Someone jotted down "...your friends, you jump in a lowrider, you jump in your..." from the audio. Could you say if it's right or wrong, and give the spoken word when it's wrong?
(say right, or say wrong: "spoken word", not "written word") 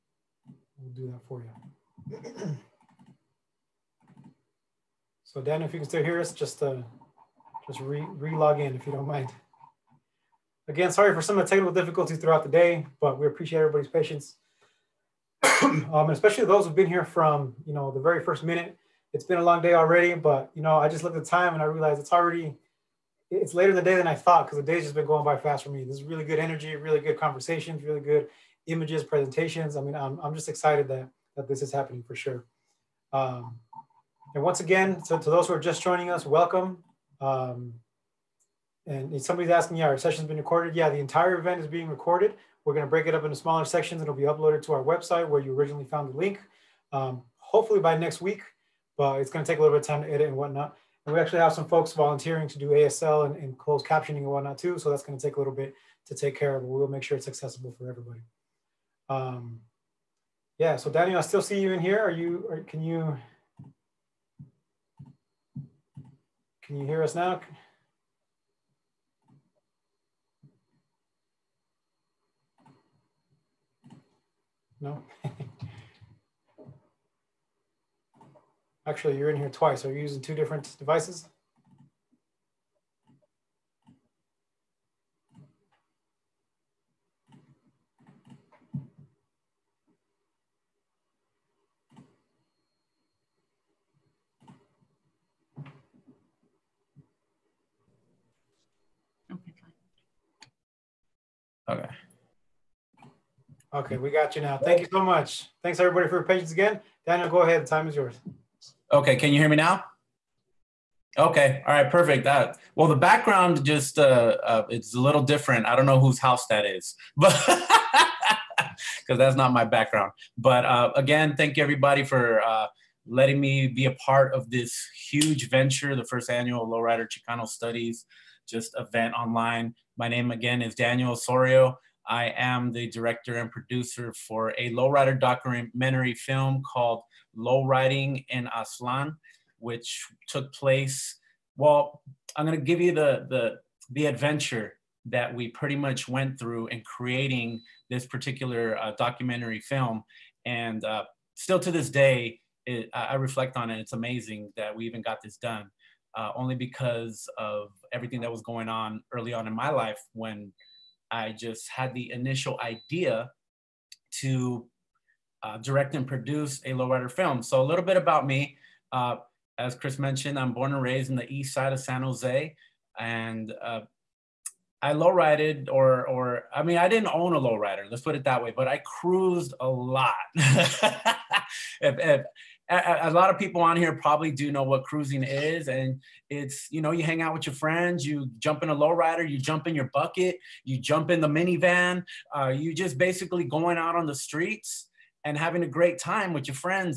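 right.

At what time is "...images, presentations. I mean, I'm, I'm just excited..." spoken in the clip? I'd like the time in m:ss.
0:28.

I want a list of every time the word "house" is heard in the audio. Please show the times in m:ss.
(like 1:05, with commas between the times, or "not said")
1:56.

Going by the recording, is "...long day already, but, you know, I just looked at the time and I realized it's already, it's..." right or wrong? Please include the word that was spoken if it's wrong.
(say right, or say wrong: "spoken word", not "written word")
right.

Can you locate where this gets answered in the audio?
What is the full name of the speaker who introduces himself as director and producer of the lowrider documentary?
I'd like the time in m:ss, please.
2:10.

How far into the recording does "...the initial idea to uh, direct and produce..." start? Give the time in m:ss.
2:41.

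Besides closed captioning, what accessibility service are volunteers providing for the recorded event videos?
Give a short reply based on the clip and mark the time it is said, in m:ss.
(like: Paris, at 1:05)
ASL, at 0:52.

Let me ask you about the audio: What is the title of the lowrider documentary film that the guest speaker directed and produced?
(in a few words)
Lowriding in Aztlán.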